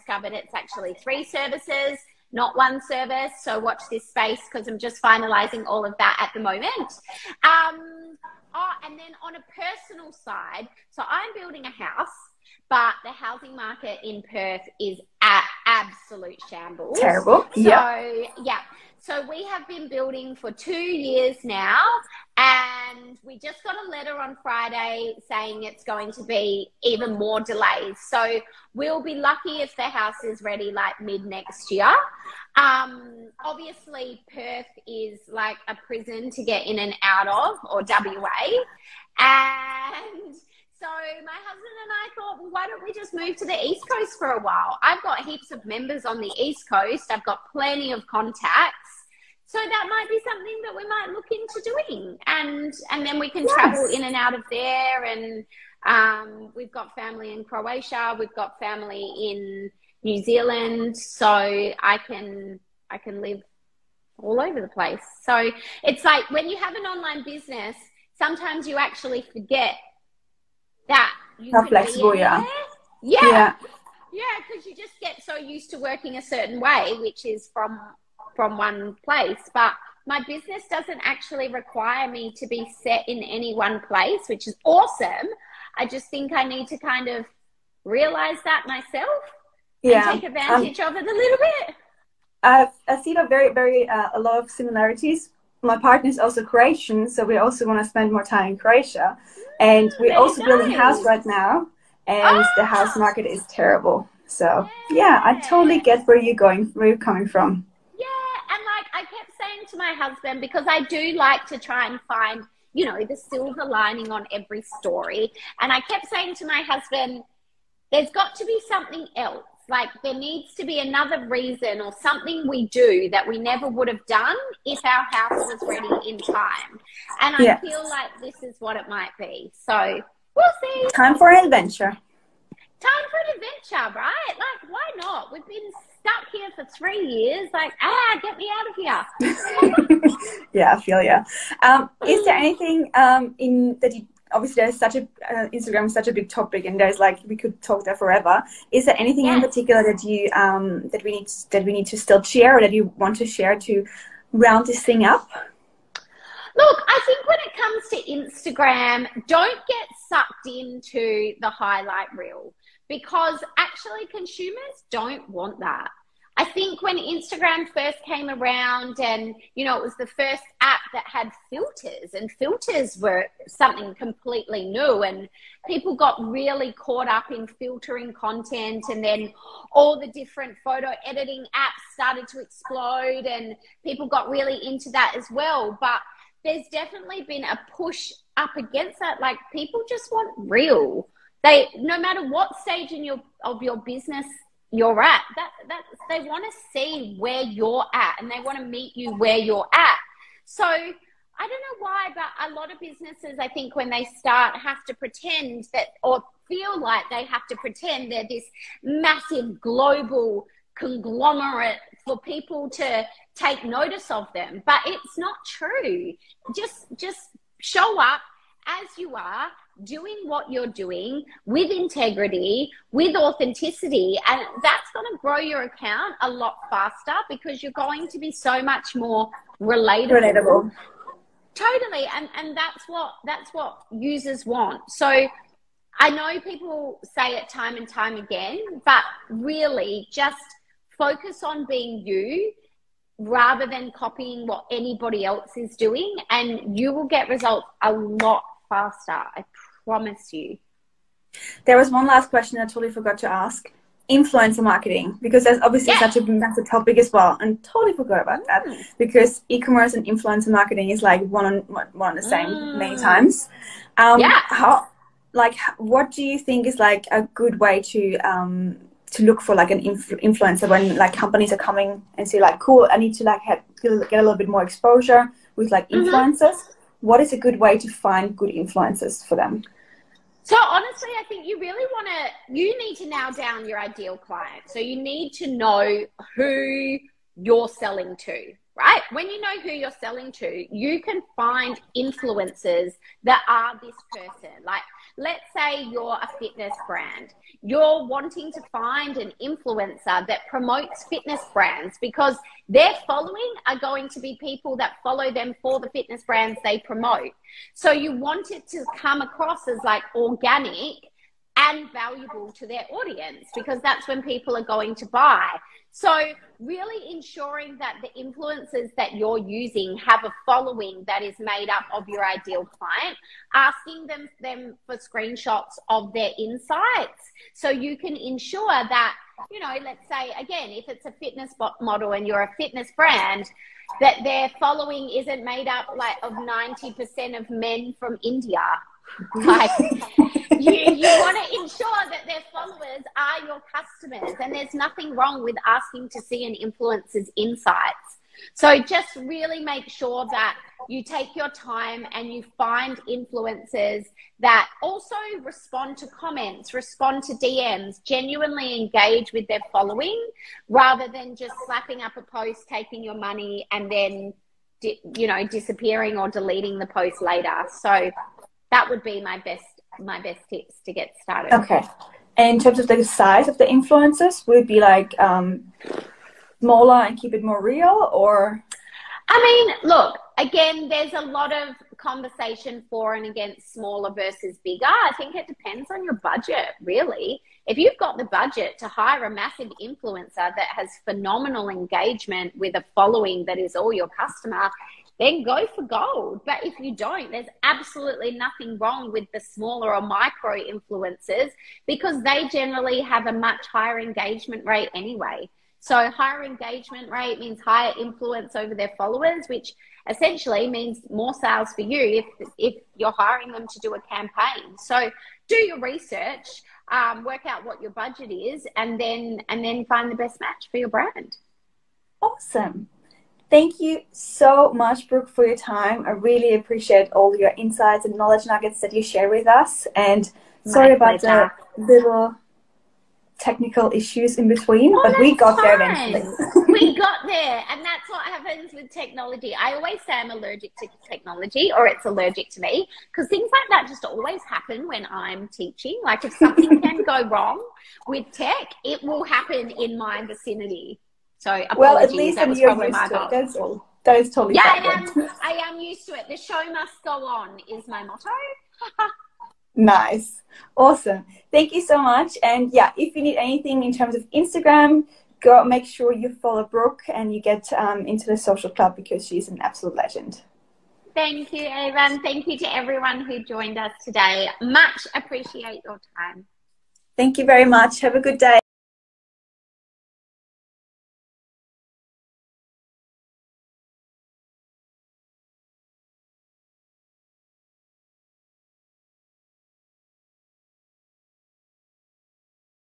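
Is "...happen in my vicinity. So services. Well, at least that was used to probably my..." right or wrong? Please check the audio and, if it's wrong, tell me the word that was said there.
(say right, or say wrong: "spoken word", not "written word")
wrong: "apologies", not "services".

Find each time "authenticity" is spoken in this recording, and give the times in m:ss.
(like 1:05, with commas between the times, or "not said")
3:43.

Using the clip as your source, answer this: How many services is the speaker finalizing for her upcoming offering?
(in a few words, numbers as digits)
3.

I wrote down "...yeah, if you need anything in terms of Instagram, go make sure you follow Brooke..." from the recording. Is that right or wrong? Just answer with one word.
right.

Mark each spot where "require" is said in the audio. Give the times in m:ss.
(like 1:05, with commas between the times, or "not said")
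1:21.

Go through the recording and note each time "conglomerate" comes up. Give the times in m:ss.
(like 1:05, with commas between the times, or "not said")
3:30.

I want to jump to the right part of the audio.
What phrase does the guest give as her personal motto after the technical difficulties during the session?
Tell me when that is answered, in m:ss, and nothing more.
7:36.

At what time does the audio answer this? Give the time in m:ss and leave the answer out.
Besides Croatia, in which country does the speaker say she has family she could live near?
1:00.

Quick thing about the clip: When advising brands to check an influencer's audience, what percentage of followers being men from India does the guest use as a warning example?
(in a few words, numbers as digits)
90%.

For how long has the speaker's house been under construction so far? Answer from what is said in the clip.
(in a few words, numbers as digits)
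2 years.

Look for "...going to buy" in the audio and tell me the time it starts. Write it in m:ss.
5:14.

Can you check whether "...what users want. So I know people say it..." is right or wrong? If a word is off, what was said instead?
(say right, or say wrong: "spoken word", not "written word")
right.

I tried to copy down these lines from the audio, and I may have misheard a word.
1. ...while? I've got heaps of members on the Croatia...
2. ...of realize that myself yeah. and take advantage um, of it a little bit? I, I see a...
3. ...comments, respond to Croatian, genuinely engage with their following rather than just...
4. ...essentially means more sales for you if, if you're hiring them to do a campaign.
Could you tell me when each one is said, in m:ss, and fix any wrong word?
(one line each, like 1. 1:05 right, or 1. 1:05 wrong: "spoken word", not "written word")
1. 0:44 wrong: "East", not "Croatia"
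2. 1:27 right
3. 5:56 wrong: "DMs", not "Croatian"
4. 6:50 right.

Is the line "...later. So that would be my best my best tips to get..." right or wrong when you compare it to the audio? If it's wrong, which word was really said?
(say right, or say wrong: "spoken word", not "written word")
right.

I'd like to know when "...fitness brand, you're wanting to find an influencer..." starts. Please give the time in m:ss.
4:56.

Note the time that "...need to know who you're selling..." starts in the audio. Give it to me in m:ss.
4:44.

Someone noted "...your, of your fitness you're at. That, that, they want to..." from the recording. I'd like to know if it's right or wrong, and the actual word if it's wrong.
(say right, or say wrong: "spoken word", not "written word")
wrong: "business", not "fitness".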